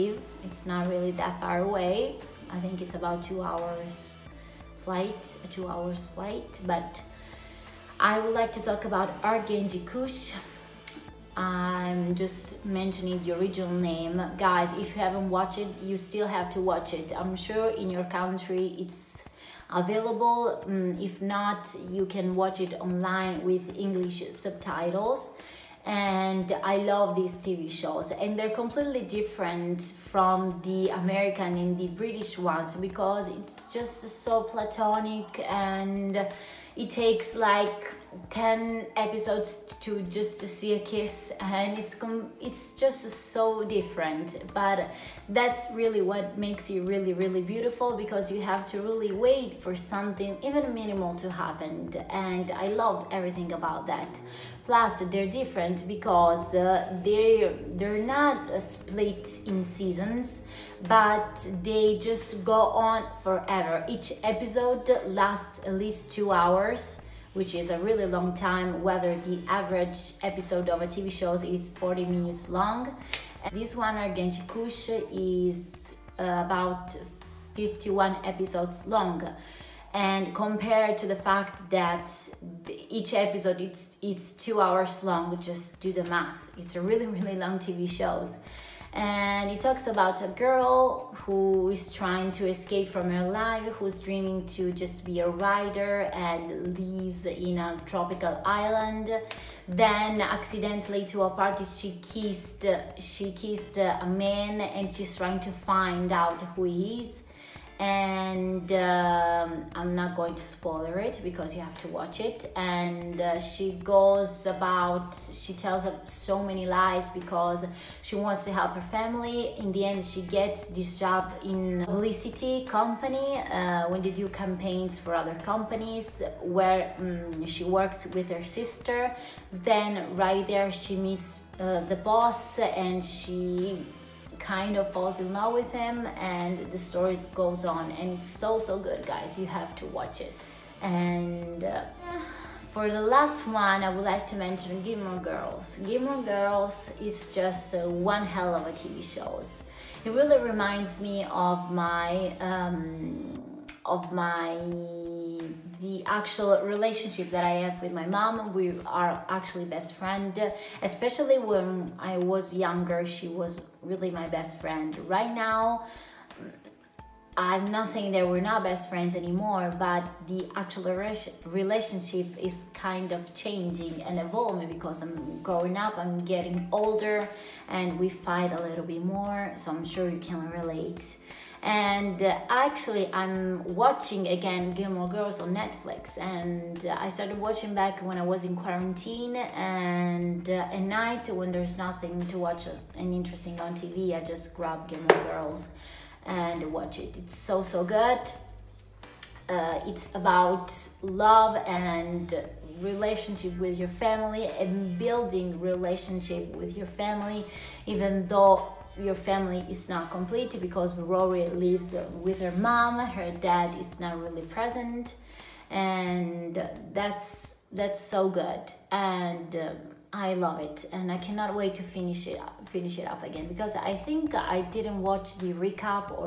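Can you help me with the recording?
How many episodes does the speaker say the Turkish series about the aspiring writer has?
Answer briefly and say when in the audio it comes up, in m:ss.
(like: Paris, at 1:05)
51, at 1:17.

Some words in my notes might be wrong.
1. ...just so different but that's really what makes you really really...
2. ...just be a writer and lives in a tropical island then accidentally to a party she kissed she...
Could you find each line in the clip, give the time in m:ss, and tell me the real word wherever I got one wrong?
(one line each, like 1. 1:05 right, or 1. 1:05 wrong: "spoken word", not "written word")
1. 0:42 right
2. 1:34 right.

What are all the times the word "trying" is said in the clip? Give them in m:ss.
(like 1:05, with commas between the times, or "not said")
1:31, 1:45.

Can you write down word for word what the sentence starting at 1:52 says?
And uh, she goes about, she tells so many lies because she wants to help her family.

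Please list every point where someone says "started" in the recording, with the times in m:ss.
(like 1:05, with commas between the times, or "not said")
3:07.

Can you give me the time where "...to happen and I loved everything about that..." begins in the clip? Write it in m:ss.
0:51.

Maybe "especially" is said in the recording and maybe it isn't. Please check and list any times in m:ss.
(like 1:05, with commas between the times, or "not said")
2:40.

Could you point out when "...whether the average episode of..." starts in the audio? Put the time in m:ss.
1:08.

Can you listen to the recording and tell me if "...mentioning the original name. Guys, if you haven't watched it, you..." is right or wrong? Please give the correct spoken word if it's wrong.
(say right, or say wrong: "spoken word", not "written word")
right.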